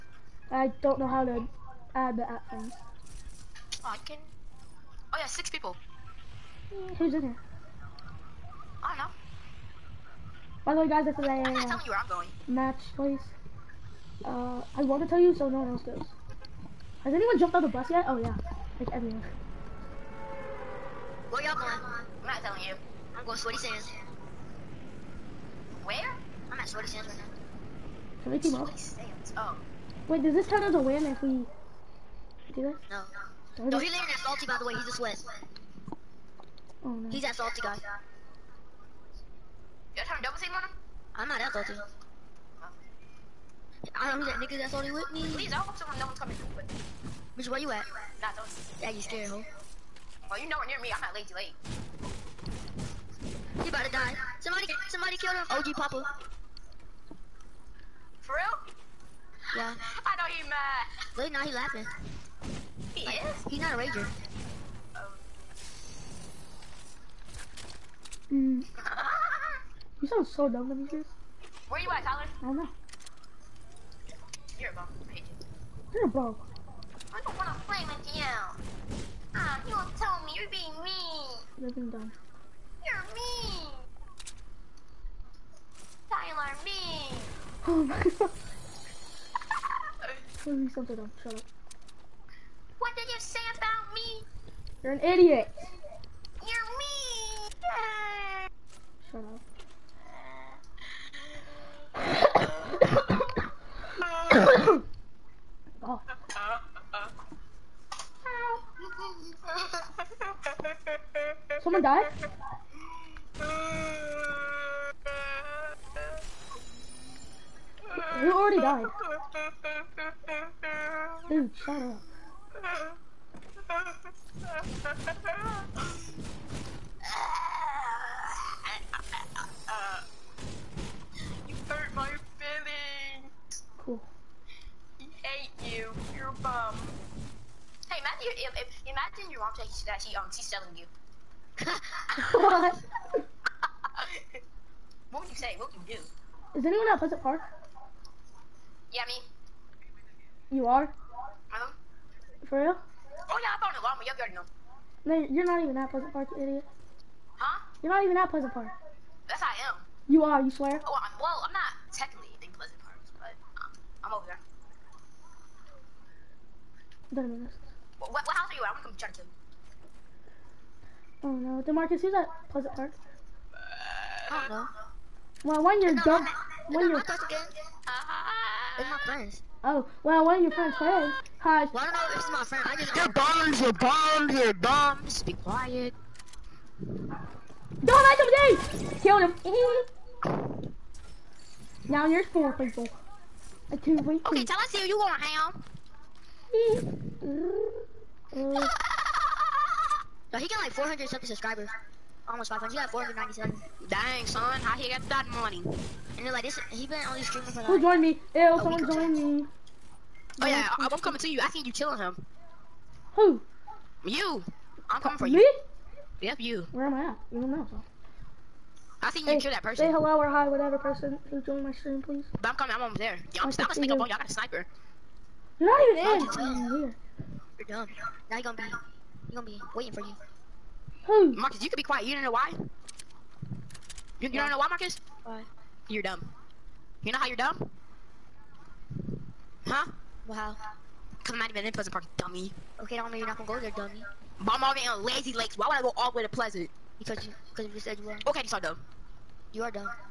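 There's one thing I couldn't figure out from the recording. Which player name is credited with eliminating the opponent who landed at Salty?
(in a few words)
OG Papa.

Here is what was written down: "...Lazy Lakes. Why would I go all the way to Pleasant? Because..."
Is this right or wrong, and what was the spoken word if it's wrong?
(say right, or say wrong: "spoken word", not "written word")
right.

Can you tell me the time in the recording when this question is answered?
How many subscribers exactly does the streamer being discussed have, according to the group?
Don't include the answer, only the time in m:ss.
3:22.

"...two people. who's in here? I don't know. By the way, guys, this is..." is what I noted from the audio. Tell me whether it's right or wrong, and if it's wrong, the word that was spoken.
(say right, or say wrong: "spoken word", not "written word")
wrong: "six", not "two".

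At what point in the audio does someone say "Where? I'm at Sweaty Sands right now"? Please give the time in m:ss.
0:25.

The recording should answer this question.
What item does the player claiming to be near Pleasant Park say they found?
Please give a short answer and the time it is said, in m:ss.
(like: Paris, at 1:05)
A llama, at 2:33.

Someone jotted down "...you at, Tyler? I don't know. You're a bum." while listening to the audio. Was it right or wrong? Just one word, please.
right.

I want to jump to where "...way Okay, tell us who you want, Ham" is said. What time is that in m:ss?
3:14.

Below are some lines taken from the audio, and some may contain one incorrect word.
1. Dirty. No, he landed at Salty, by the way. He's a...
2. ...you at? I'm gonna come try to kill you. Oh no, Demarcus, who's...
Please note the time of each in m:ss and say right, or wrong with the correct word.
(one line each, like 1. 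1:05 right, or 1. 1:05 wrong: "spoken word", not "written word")
1. 0:33 right
2. 2:48 right.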